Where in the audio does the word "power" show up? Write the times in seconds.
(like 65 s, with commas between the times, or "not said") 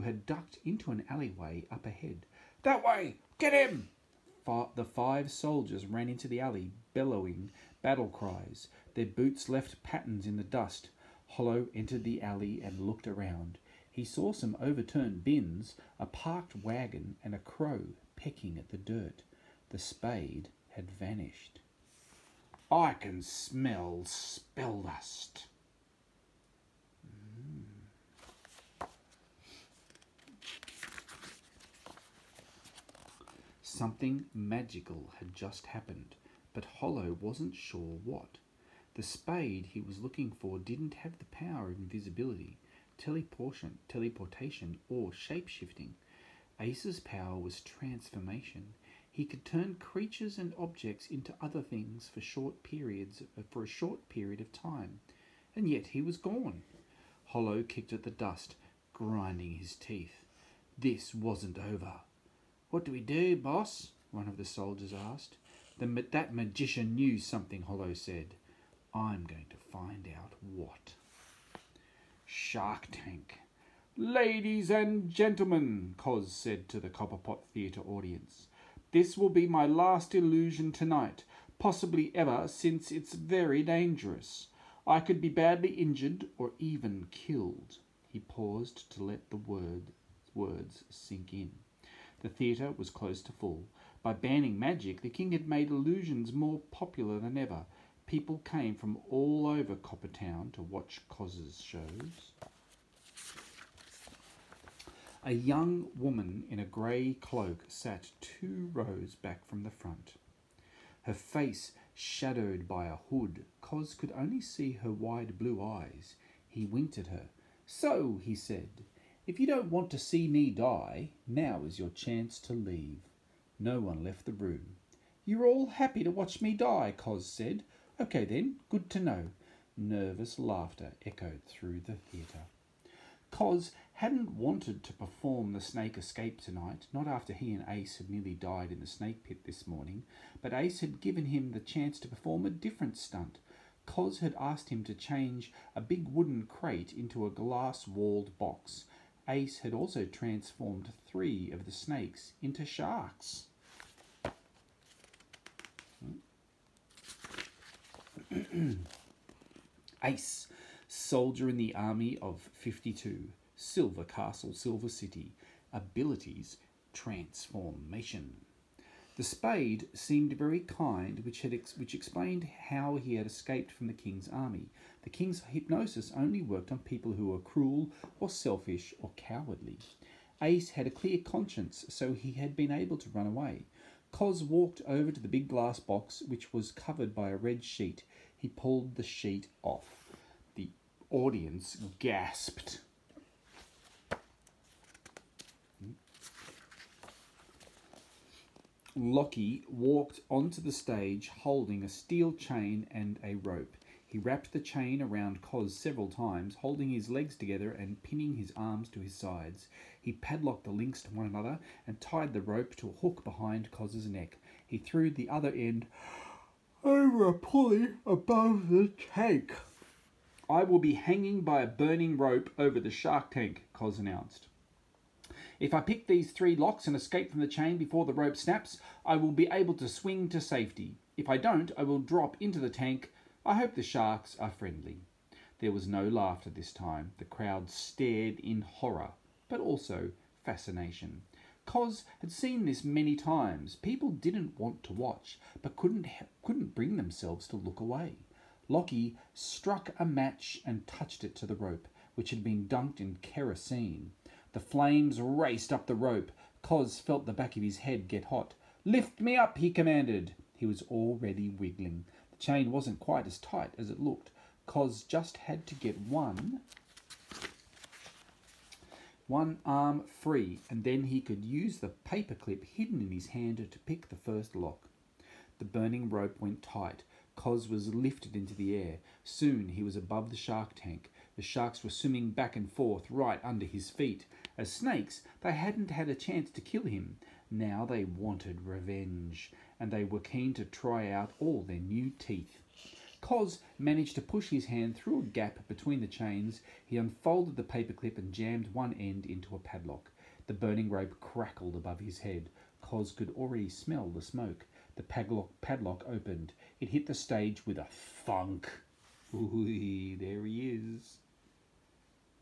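41 s, 46 s.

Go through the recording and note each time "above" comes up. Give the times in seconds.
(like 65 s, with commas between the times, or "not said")
218 s, 279 s, 301 s.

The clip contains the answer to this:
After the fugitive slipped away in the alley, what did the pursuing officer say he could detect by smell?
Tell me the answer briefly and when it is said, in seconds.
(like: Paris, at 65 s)
Spell dust, at 24 s.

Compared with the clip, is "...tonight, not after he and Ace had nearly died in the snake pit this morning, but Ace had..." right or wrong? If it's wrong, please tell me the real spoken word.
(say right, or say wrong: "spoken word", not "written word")
right.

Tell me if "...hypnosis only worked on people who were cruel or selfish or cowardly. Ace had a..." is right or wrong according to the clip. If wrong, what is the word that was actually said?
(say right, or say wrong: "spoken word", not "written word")
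right.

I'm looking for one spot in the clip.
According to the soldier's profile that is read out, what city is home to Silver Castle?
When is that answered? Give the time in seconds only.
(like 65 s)
164 s.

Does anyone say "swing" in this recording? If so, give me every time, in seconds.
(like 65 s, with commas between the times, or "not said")
229 s.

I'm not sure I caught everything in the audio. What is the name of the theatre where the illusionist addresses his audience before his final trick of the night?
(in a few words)
Copperpot Theatre.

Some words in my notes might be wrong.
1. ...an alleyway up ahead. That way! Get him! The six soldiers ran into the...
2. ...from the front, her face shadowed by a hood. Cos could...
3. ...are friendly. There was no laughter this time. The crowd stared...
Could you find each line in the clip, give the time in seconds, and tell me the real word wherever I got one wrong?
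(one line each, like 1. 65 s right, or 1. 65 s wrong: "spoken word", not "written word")
1. 0 s wrong: "five", not "six"
2. 109 s right
3. 234 s right.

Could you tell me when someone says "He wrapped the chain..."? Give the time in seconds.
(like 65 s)
204 s.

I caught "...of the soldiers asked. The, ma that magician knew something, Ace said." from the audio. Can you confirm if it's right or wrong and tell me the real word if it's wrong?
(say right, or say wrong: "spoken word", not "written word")
wrong: "Hollow", not "Ace".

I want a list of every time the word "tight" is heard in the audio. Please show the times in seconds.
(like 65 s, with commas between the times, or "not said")
263 s, 276 s.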